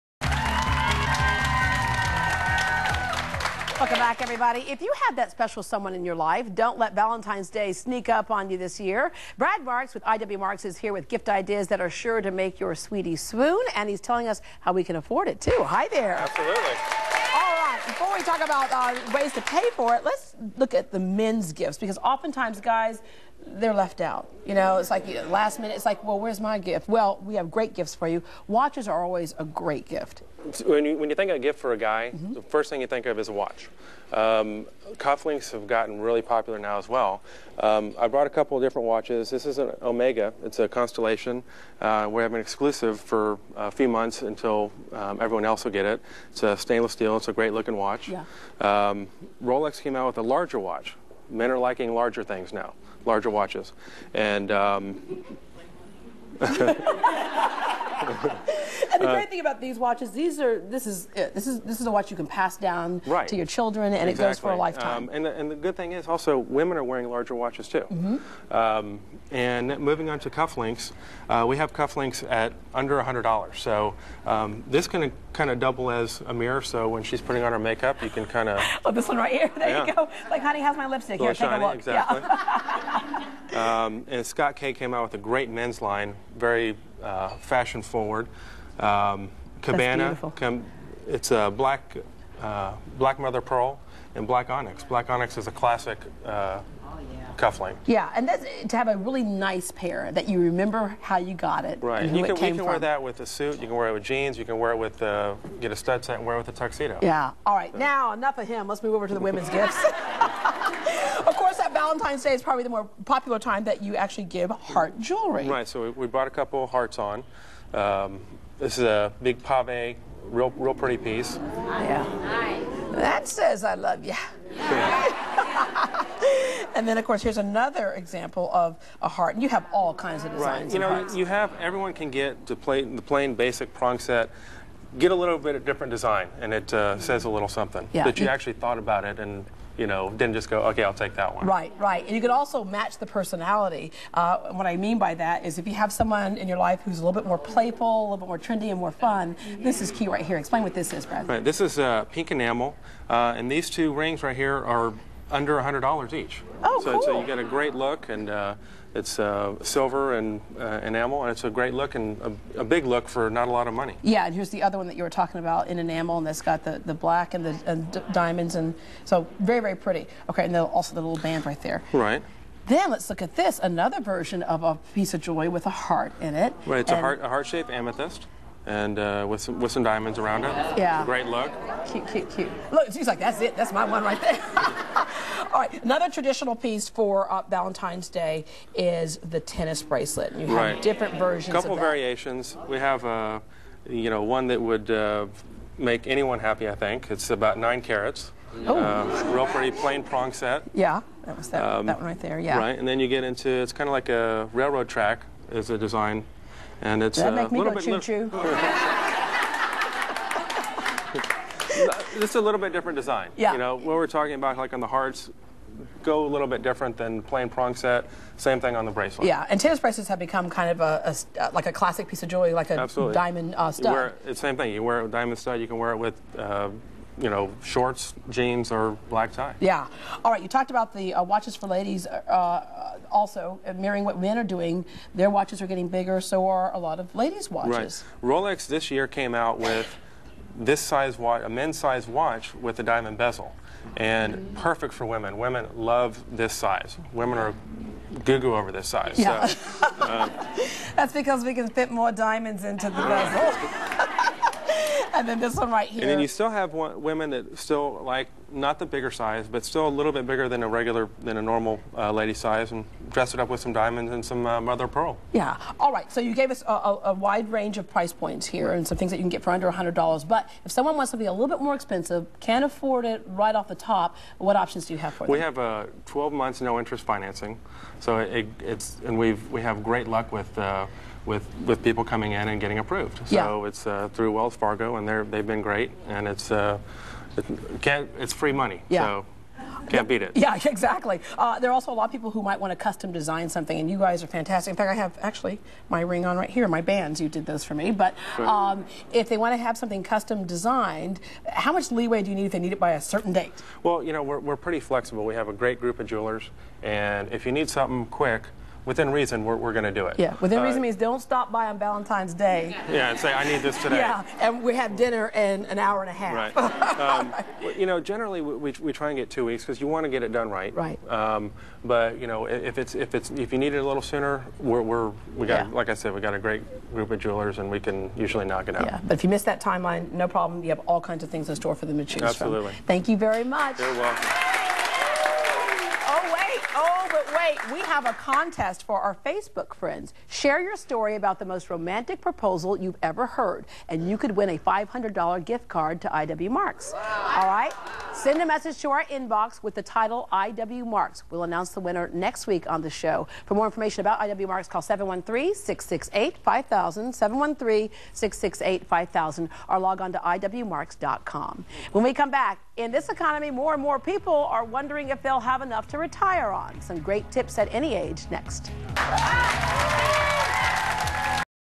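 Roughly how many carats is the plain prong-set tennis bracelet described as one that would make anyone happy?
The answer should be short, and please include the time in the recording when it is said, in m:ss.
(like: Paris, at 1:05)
9 carats, at 3:17.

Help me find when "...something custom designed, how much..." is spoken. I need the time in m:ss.
4:59.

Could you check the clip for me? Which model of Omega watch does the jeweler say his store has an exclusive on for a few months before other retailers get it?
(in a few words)
Constellation.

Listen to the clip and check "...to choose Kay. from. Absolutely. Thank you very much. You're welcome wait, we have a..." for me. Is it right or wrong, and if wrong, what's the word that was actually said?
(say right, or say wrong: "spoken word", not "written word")
wrong: "Absolutely", not "Kay".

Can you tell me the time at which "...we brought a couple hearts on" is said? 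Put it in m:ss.
1:55.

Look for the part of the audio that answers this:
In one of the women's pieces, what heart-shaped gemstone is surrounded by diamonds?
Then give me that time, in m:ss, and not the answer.
2:57.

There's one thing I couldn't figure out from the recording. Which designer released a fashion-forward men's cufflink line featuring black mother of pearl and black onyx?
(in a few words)
Scott Kay.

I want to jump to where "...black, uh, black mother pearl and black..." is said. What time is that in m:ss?
1:31.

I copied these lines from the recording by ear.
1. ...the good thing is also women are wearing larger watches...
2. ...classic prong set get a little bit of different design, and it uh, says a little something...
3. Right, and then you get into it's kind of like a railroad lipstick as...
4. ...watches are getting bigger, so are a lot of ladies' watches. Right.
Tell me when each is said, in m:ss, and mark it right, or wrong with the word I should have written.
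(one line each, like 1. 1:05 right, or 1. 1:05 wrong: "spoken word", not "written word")
1. 1:05 right
2. 2:13 wrong: "basic", not "classic"
3. 3:22 wrong: "track", not "lipstick"
4. 3:55 right.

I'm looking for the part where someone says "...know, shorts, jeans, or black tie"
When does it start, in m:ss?
3:47.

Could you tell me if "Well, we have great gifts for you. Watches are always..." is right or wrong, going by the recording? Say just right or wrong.
right.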